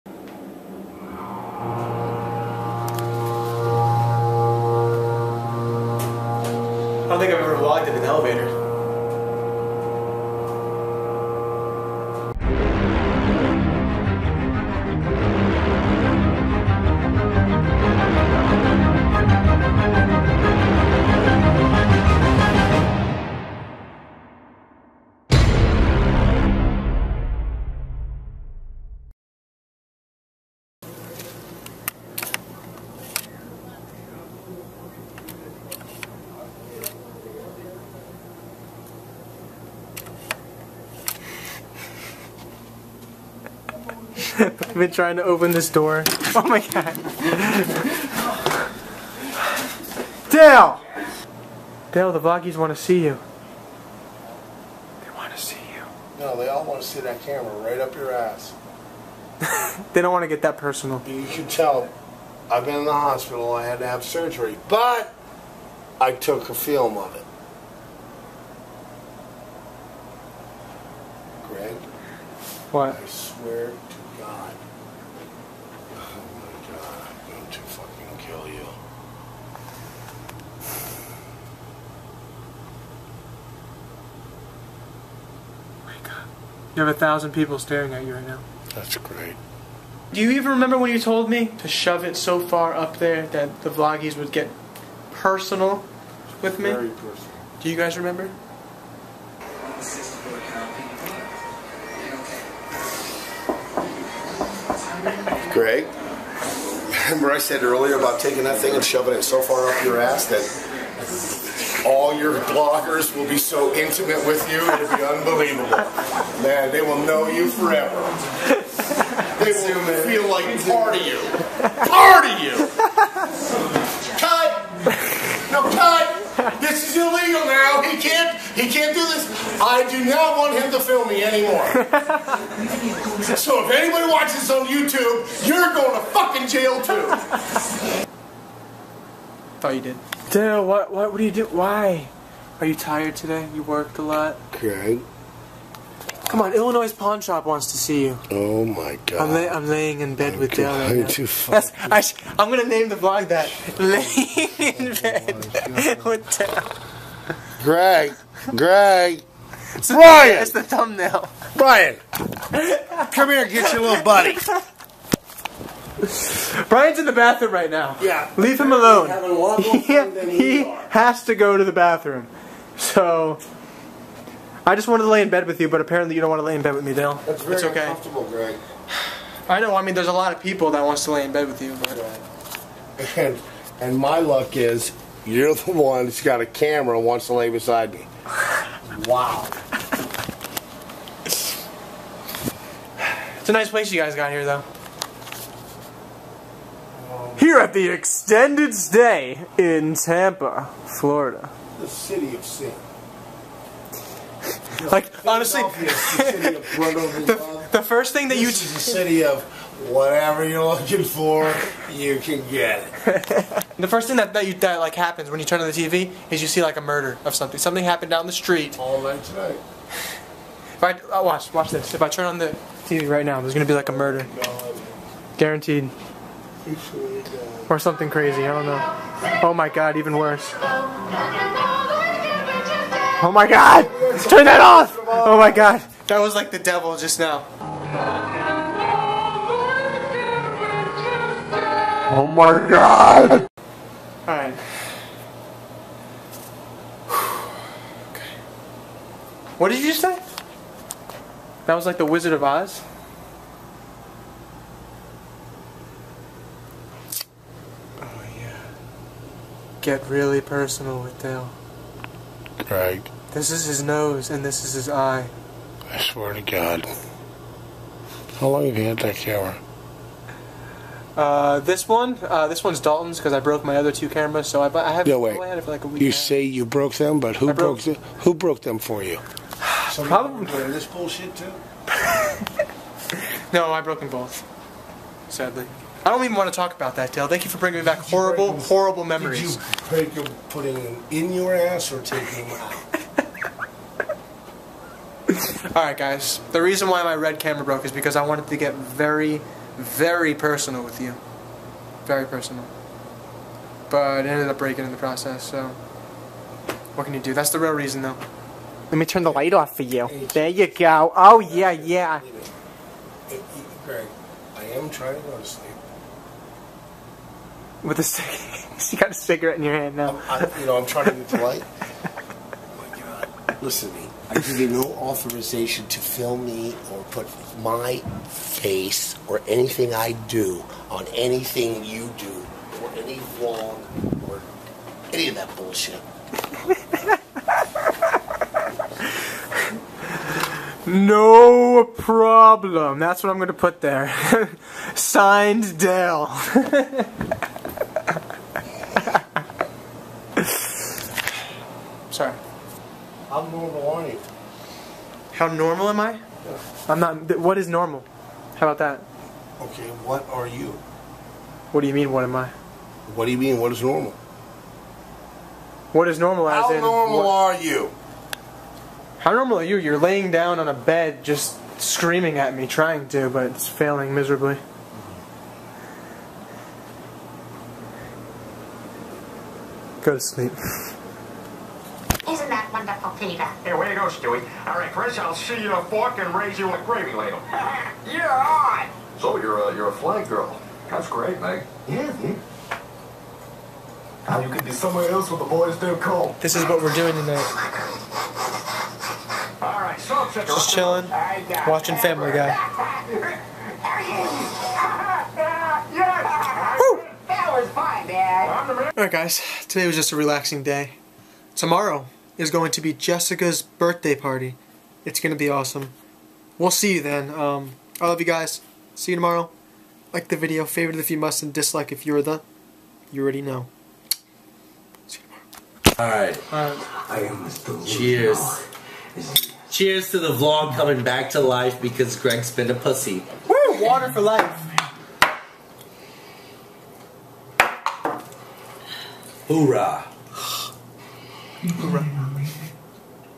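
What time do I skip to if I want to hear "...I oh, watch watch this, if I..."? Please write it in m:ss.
3:40.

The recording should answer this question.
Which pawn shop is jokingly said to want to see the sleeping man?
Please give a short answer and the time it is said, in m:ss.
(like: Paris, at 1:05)
Illinois Pawn Shop, at 2:26.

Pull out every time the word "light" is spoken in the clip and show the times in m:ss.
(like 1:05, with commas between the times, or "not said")
5:09, 5:21.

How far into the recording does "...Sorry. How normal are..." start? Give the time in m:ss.
5:52.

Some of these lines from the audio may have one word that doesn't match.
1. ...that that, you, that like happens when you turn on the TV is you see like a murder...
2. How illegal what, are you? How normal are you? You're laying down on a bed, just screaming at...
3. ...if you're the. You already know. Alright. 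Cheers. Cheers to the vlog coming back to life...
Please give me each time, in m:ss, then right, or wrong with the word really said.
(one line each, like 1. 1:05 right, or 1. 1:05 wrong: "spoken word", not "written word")
1. 3:34 right
2. 6:06 wrong: "normal", not "illegal"
3. 7:01 right.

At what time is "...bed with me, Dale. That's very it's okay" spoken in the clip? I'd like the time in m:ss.
2:56.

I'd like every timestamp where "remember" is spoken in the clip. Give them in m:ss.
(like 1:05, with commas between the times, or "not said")
1:30, 1:37, 1:47.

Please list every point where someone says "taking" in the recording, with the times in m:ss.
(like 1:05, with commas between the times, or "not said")
1:48, 4:52.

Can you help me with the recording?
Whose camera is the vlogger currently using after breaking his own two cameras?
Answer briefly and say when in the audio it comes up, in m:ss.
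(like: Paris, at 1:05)
Dalton's, at 4:32.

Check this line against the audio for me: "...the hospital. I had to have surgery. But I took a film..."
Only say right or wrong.
right.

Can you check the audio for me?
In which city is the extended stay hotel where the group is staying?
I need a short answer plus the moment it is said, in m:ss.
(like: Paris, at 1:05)
Tampa, Florida, at 3:19.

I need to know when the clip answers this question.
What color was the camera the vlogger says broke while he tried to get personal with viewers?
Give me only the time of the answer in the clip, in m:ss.
4:57.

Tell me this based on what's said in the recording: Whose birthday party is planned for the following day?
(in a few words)
Jessica's.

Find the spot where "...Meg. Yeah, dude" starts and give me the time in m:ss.
6:31.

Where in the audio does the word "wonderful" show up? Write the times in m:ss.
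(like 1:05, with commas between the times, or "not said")
6:22.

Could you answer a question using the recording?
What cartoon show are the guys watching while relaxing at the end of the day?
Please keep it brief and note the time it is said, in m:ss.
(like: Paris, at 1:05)
Family Guy, at 6:41.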